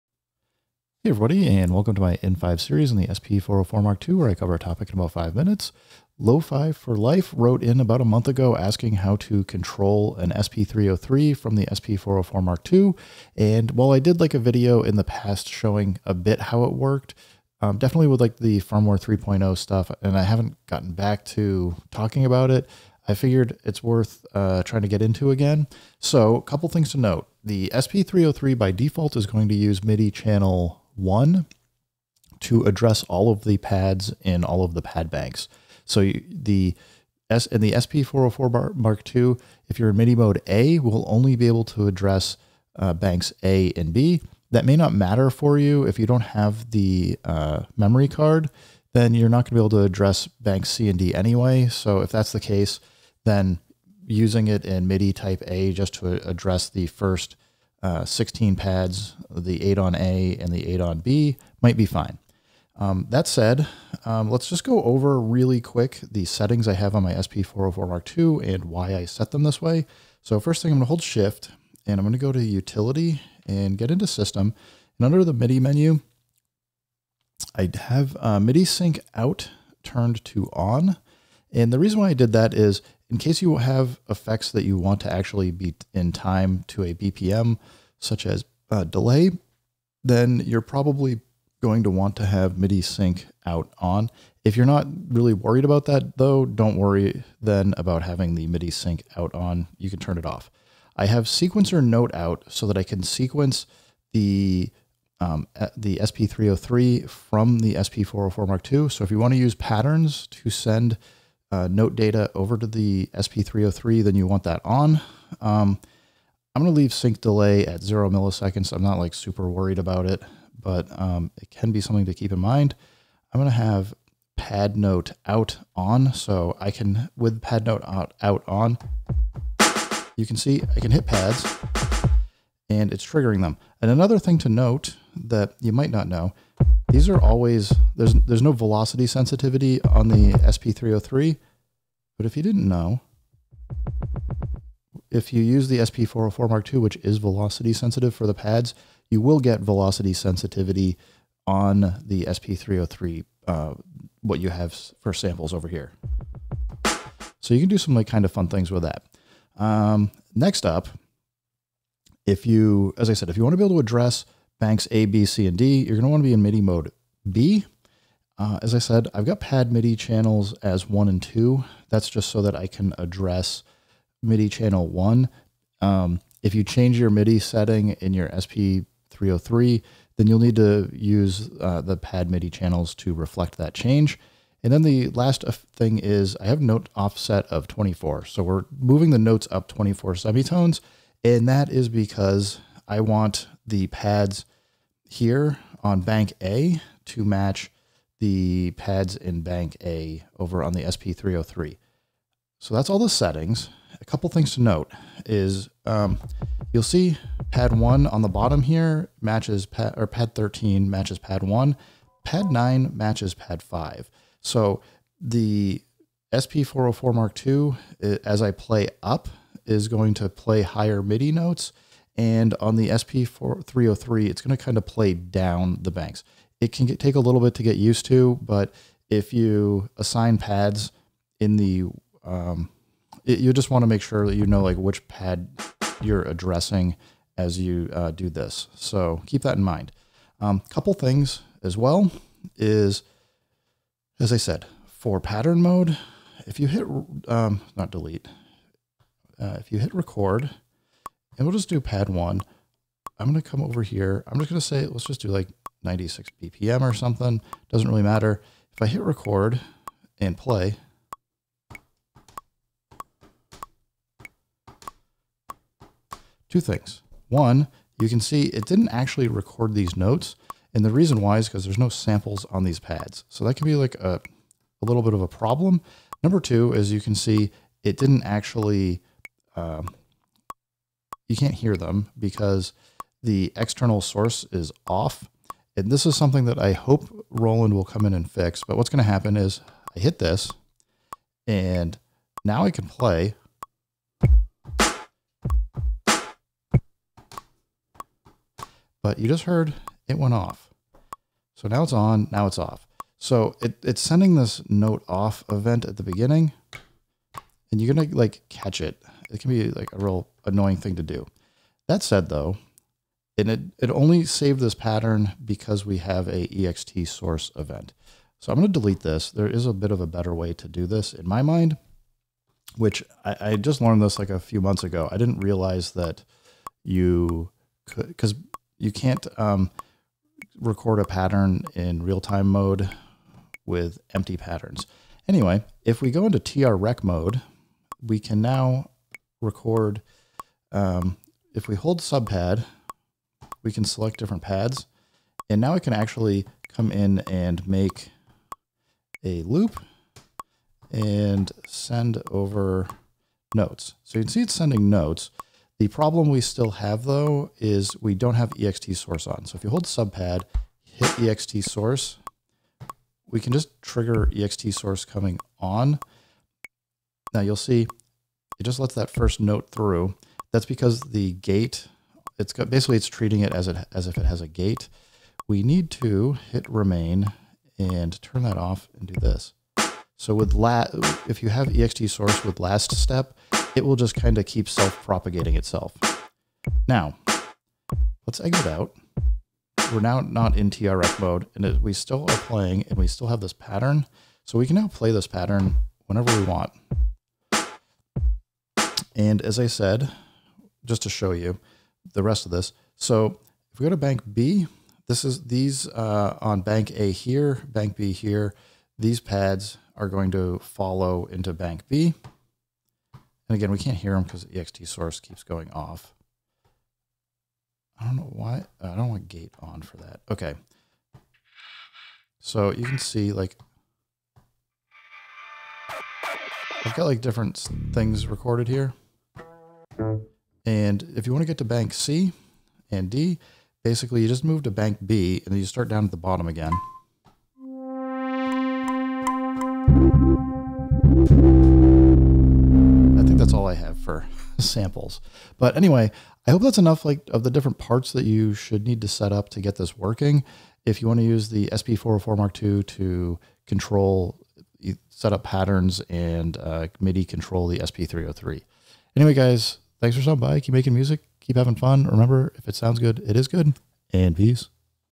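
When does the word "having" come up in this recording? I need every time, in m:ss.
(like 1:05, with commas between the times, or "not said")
1:38, 7:41.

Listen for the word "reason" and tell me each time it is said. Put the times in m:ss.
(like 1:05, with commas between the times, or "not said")
1:21, 4:30.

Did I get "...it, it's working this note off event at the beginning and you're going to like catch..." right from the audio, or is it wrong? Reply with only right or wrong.
wrong.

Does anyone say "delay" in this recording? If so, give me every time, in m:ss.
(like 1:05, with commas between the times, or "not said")
1:28, 1:57.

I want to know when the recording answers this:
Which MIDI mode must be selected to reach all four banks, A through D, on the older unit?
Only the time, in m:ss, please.
2:46.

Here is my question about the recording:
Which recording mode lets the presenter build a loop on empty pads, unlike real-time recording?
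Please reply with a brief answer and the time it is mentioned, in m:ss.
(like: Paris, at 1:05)
TR rec mode, at 5:36.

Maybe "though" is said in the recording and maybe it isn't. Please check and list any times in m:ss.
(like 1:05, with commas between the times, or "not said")
1:36, 5:12, 5:57.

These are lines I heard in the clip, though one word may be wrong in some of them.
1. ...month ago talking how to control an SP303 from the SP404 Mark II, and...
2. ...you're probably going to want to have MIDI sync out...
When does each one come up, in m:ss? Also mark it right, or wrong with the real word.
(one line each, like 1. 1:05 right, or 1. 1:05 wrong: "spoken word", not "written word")
1. 0:08 wrong: "asking", not "talking"
2. 1:30 right.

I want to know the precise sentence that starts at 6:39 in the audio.
And as I said, just to show you the rest of this.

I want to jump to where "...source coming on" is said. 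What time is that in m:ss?
6:04.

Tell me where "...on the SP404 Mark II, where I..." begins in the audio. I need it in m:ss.
0:02.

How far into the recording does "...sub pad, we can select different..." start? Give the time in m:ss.
5:42.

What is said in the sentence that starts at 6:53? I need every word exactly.
And again, we can't hear them because the ext source keeps going off.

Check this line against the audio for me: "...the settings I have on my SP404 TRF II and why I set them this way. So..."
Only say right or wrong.
wrong.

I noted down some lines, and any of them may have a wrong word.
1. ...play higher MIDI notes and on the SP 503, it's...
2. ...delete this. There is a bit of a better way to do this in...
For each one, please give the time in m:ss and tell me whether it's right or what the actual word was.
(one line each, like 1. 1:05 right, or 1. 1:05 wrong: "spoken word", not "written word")
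1. 3:40 wrong: "303", not "503"
2. 5:18 right.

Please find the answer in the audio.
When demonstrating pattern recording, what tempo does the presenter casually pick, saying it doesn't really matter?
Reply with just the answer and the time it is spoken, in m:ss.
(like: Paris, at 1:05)
96 BPM, at 4:15.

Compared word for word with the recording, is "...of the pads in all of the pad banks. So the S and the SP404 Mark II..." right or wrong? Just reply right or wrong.
right.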